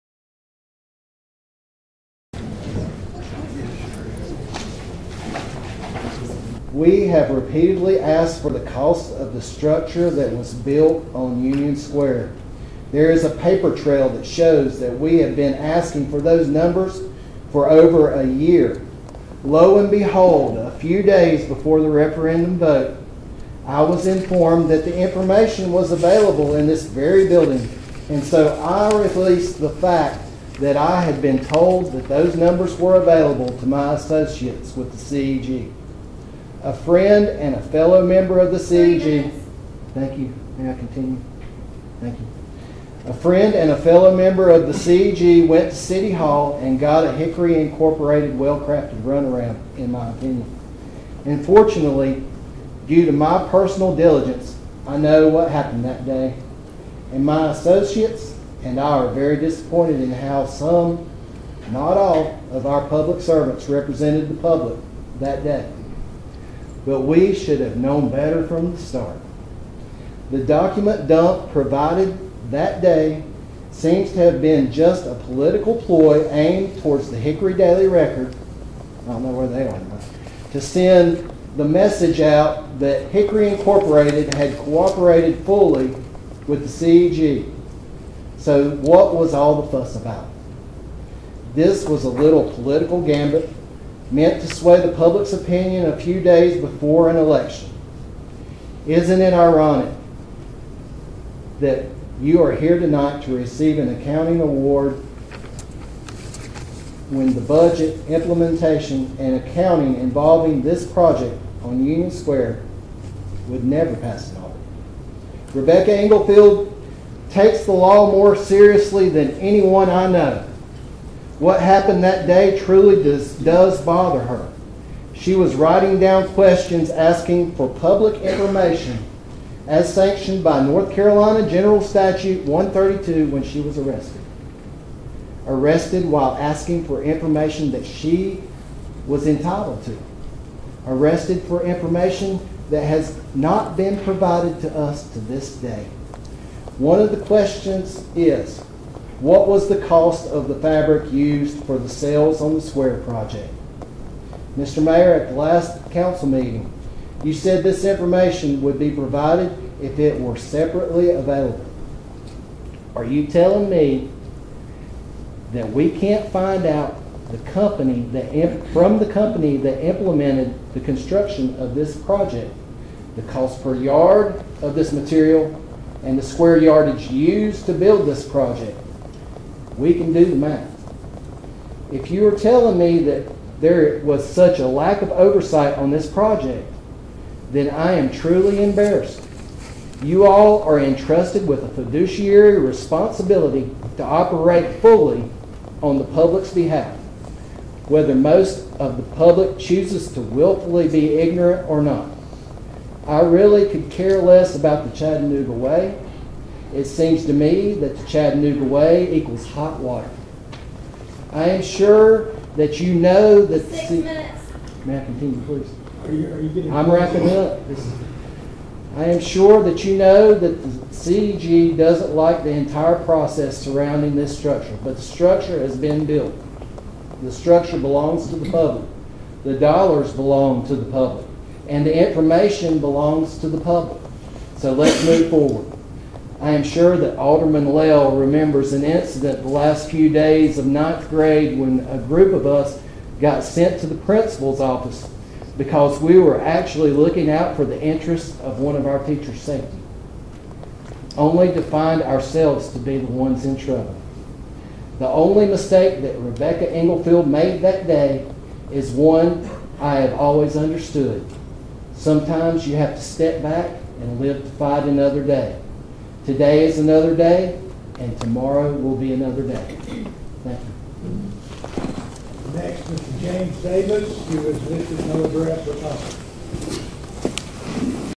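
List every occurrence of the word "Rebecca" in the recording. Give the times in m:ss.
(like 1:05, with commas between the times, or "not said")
1:55, 4:16.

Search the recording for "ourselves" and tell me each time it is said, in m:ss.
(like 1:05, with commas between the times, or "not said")
4:12.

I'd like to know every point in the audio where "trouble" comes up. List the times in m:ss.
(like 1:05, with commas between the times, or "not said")
4:13.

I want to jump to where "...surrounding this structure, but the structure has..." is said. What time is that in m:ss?
3:43.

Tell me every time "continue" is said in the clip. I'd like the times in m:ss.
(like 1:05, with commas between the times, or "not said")
0:40, 3:35.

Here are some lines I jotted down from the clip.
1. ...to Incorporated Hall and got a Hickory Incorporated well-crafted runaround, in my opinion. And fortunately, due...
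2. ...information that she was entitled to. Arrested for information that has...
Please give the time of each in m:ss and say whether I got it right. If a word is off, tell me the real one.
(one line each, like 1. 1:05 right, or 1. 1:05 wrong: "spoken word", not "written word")
1. 0:45 wrong: "City", not "Incorporated"
2. 2:17 right.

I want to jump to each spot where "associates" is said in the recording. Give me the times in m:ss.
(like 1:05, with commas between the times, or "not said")
0:33, 0:57.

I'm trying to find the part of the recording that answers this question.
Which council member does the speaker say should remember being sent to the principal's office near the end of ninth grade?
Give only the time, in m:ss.
3:57.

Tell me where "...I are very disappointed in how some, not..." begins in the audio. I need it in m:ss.
0:58.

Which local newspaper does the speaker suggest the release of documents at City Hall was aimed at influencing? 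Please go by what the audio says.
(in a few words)
Hickory Daily Record.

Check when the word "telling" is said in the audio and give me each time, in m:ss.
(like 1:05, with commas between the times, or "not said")
2:43, 3:02.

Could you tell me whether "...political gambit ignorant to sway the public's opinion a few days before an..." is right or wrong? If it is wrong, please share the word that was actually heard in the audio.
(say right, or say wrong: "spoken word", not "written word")
wrong: "meant", not "ignorant".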